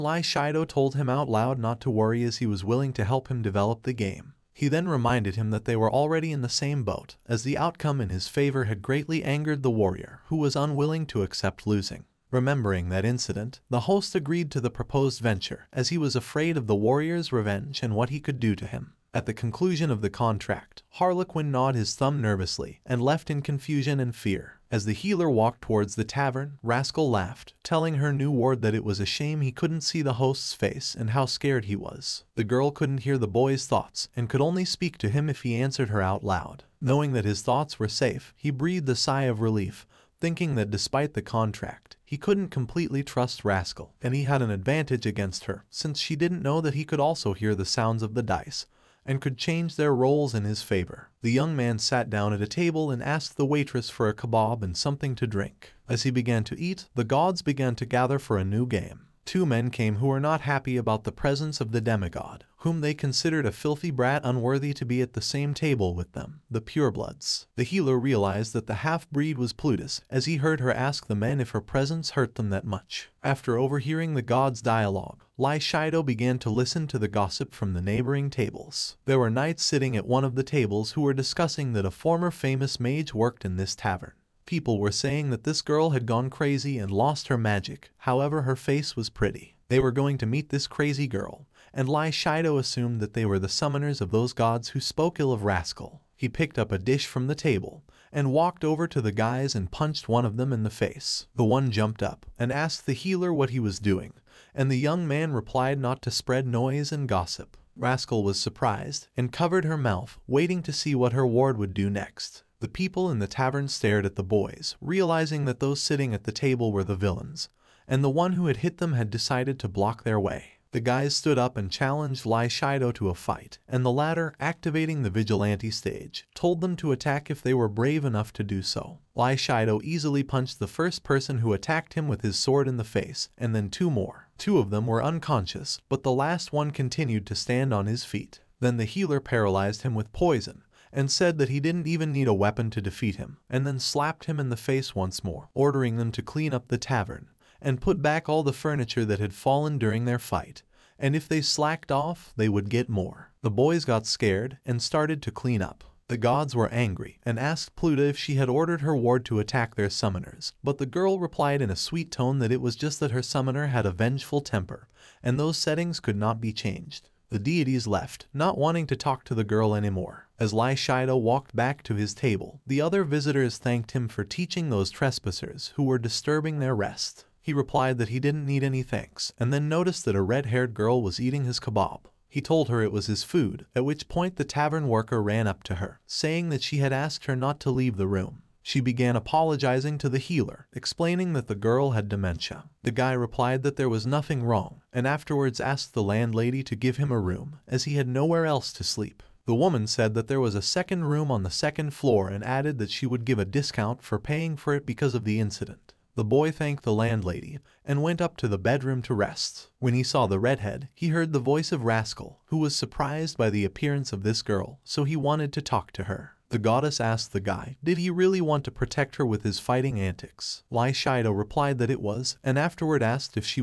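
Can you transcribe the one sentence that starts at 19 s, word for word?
At the conclusion of the contract, Harlequin gnawed his thumb nervously and left in confusion and fear.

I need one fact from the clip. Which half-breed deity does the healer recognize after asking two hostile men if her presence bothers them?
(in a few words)
Plutus.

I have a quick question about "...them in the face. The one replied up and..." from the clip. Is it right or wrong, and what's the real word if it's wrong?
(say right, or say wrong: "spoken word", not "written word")
wrong: "jumped", not "replied".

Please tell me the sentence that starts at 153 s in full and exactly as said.
The boys got scared and started to clean up.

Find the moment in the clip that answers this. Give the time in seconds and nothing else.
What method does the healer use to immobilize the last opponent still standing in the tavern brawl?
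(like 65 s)
140 s.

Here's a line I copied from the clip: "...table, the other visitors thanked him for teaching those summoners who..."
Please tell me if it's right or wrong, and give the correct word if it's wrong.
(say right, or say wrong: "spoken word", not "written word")
wrong: "trespassers", not "summoners".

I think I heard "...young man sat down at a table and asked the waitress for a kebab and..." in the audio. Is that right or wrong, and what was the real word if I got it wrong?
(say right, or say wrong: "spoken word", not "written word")
right.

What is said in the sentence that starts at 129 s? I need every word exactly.
Lai Shido easily punched the first person who attacked him with his sword in the face, and then two more.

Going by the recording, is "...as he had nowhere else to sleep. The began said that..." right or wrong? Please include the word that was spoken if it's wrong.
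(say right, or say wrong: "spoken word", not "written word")
wrong: "woman", not "began".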